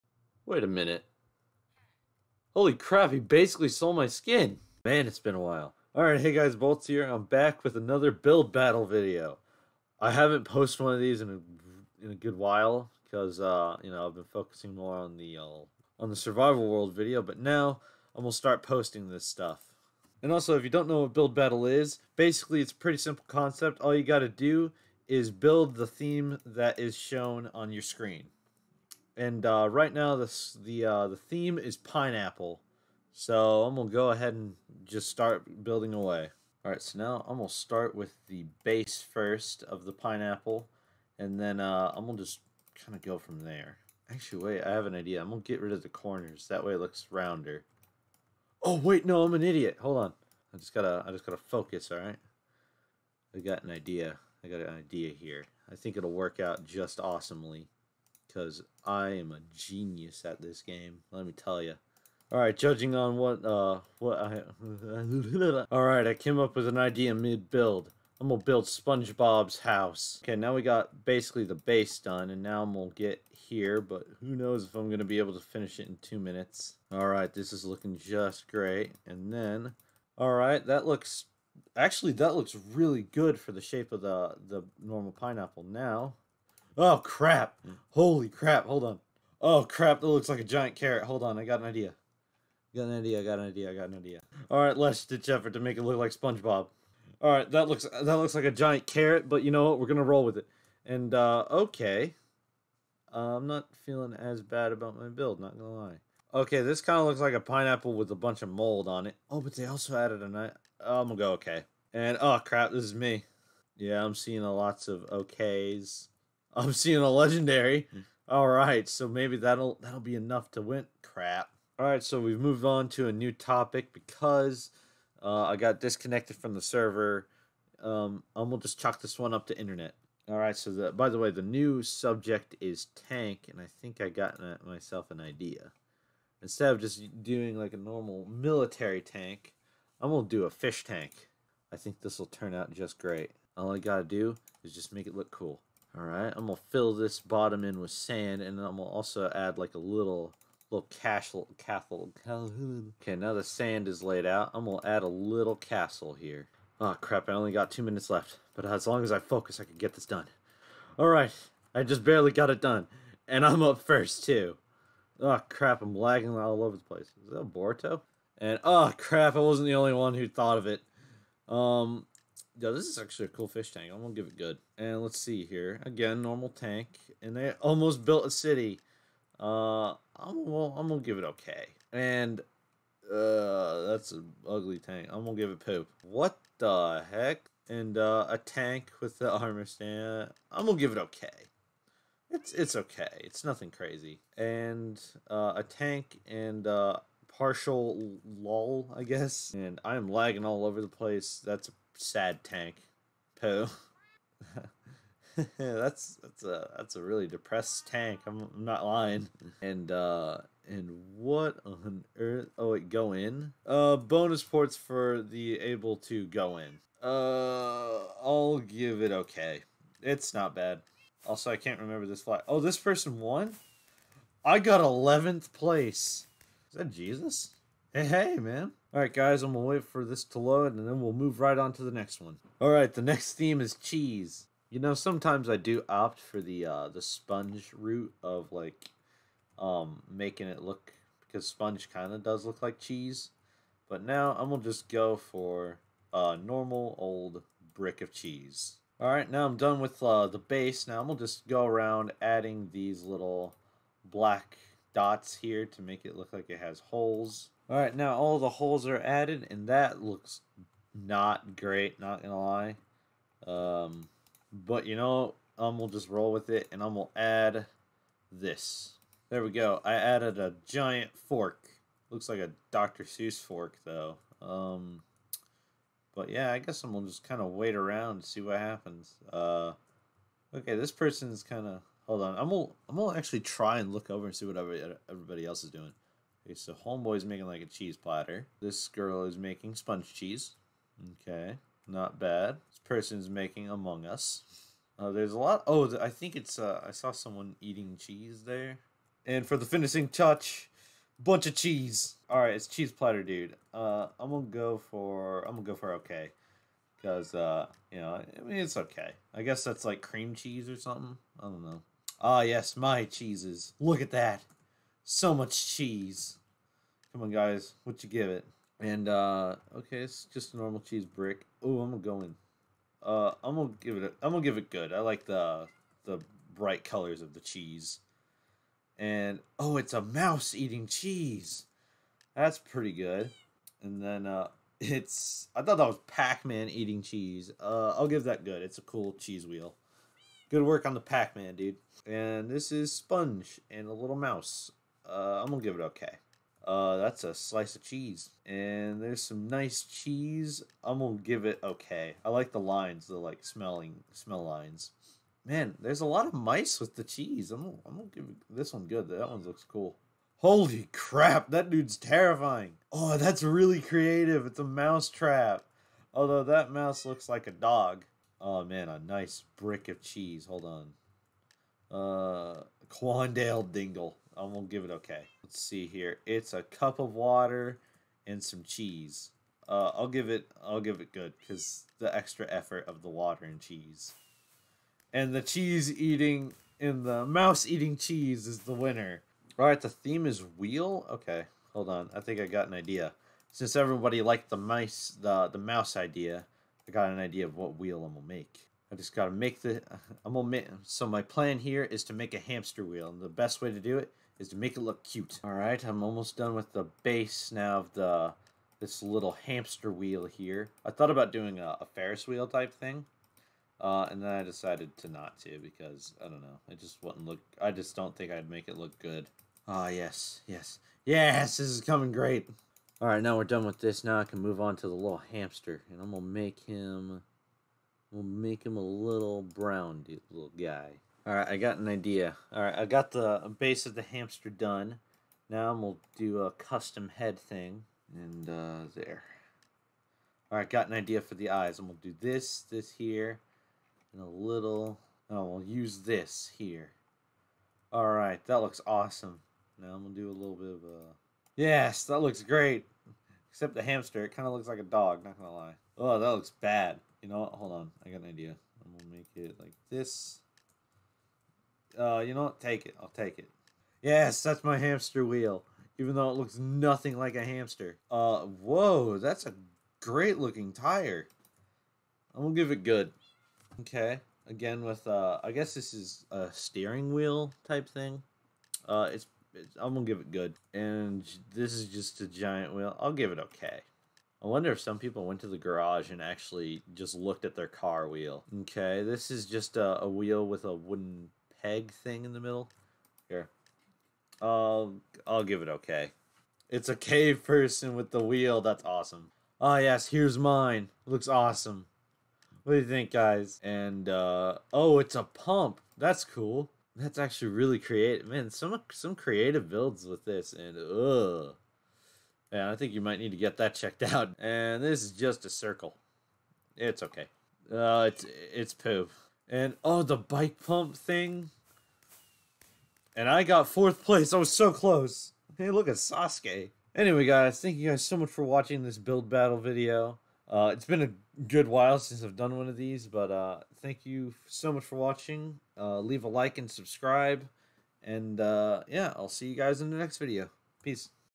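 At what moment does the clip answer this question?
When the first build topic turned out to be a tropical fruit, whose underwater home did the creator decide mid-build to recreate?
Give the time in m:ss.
1:08.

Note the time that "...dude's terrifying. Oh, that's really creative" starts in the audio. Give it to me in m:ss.
6:01.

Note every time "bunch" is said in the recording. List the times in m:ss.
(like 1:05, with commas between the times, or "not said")
1:48, 5:01.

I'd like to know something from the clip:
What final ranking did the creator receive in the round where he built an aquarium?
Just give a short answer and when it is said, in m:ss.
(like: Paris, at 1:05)
Eleventh place, at 3:44.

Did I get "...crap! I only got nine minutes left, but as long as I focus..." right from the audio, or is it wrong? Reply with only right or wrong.
wrong.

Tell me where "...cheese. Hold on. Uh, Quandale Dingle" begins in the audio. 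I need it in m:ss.
6:10.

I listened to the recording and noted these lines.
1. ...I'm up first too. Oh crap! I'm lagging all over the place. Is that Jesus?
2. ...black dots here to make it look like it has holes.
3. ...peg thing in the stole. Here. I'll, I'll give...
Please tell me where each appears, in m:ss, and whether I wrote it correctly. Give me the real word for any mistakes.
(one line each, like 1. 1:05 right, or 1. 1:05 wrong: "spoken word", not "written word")
1. 2:43 wrong: "Borto", not "Jesus"
2. 4:14 right
3. 8:11 wrong: "middle", not "stole".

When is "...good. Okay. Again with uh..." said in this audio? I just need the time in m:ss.
7:52.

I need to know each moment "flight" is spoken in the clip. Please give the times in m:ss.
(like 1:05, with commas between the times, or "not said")
3:42.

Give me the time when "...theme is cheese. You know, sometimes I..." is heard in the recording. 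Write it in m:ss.
3:53.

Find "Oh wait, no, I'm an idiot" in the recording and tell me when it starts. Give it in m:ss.
0:48.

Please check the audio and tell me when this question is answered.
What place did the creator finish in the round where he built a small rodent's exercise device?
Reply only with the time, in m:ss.
8:43.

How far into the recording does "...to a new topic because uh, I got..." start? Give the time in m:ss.
2:02.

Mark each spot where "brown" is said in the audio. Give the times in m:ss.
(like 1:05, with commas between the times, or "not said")
7:09.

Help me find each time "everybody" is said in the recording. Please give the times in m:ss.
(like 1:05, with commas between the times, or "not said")
4:44, 6:33.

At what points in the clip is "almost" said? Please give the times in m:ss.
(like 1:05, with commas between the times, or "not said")
2:57, 6:46.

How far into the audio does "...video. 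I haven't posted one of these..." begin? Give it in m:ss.
0:08.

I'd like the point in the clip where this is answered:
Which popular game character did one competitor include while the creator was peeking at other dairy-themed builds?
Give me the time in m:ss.
4:53.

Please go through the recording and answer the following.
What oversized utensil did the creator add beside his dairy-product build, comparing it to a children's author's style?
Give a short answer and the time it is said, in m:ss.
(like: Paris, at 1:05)
A giant fork, at 4:30.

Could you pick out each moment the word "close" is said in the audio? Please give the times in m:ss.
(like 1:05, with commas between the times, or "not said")
8:44.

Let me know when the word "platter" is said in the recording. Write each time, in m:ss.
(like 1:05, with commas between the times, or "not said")
4:47, 5:02.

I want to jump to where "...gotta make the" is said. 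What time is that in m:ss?
6:39.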